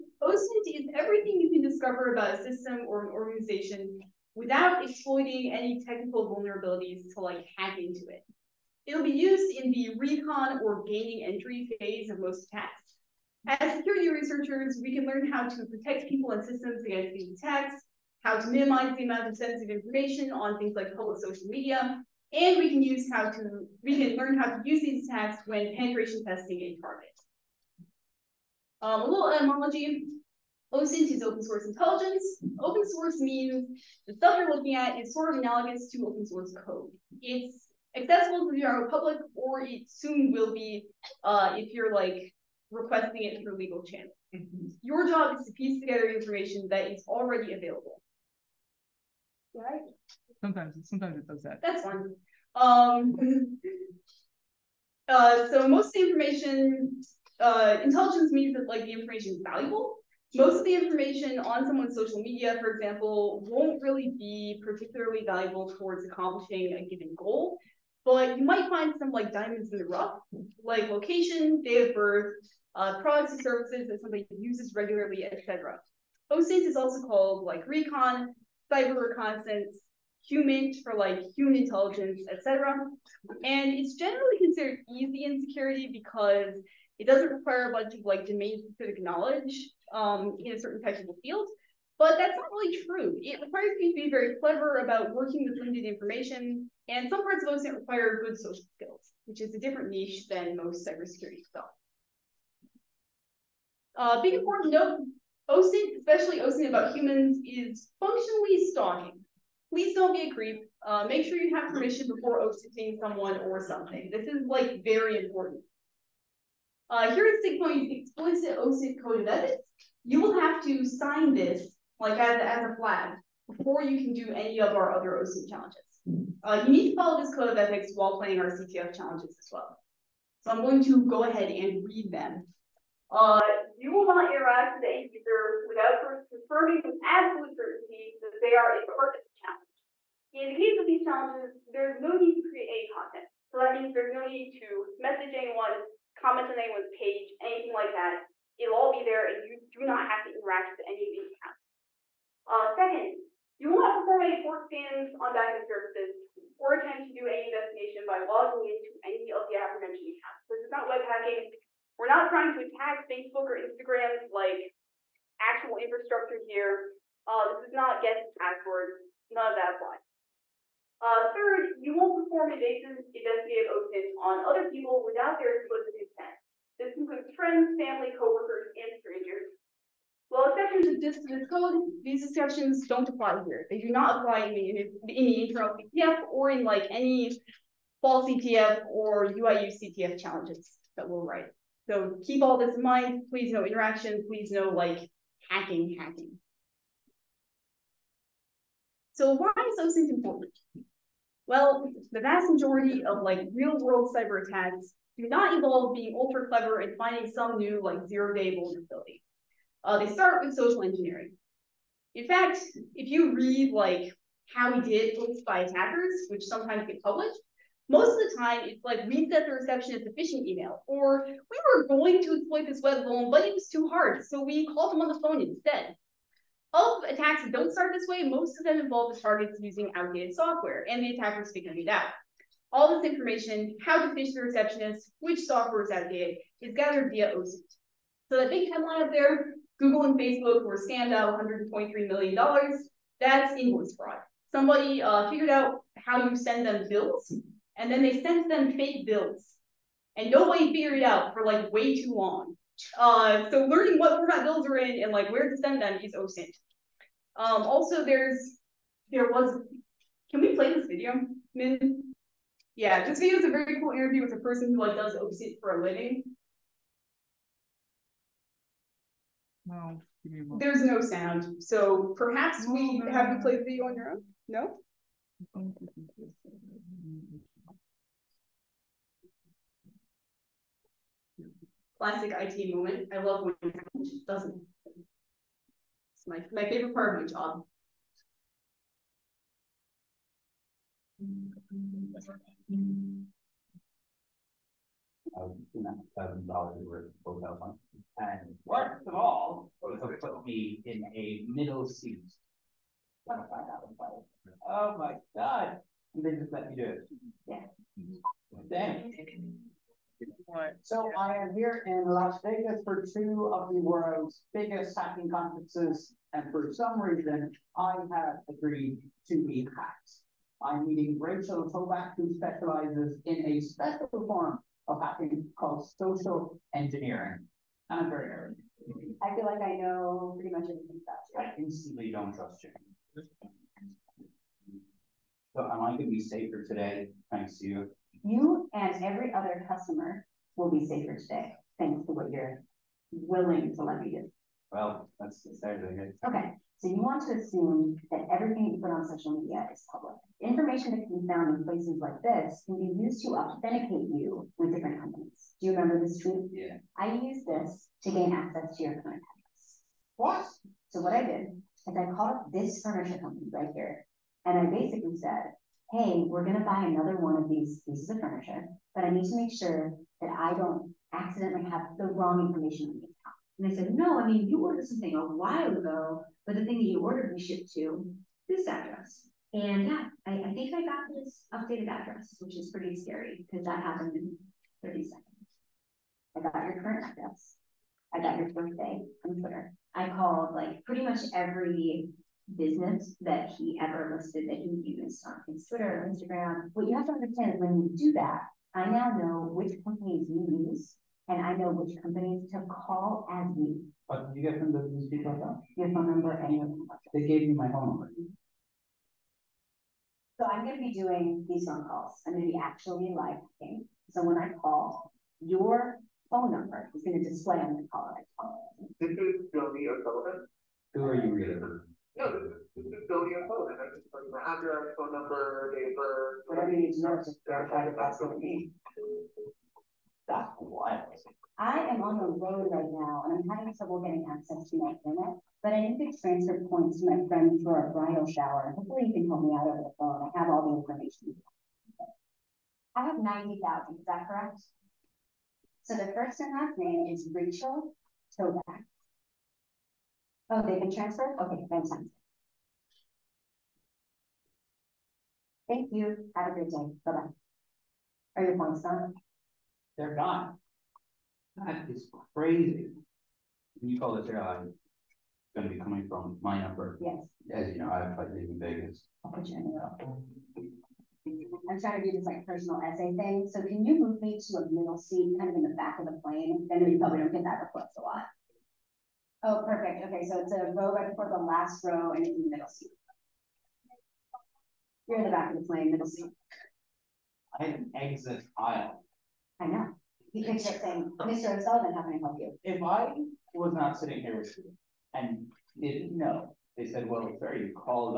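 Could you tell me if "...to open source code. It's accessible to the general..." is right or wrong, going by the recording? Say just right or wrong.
right.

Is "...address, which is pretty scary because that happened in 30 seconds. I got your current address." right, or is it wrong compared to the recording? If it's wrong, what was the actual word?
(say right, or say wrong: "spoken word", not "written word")
right.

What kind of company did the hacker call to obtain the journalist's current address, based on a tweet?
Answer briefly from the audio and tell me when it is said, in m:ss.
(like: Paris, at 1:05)
furniture company, at 6:02.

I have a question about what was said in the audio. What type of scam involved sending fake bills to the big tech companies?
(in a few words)
invoice fraud.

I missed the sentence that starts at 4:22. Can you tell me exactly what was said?
Yeah, this video is a very cool interview with a person who like does OSINT for a living.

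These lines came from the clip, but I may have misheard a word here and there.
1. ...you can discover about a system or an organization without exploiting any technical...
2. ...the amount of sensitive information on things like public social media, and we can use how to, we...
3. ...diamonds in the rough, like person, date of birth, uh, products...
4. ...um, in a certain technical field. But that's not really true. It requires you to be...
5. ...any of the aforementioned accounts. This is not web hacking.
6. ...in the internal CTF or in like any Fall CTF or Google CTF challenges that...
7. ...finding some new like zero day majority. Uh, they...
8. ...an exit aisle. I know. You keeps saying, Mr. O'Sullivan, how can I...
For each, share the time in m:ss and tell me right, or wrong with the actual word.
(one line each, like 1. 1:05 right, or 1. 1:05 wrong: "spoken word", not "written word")
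1. 0:01 right
2. 0:18 right
3. 1:09 wrong: "location", not "person"
4. 1:29 right
5. 2:39 right
6. 3:04 wrong: "UIU", not "Google"
7. 3:26 wrong: "vulnerability", not "majority"
8. 8:07 right.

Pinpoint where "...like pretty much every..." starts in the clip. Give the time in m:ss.
6:30.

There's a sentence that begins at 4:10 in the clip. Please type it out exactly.
And nobody figured it out for like way too long.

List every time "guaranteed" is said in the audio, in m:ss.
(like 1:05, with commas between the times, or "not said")
not said.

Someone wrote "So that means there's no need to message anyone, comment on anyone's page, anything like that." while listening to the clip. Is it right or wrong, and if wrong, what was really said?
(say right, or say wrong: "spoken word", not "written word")
right.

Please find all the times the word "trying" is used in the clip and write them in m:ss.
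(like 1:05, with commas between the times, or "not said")
2:42, 7:51.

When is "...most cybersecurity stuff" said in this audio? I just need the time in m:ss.
1:40.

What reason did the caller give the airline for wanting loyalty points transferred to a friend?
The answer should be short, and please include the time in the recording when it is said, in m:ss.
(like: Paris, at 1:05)
a bridal shower, at 7:17.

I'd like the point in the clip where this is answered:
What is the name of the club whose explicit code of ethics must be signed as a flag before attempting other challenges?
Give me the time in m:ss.
1:57.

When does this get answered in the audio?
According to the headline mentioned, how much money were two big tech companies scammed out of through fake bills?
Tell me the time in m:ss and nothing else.
4:01.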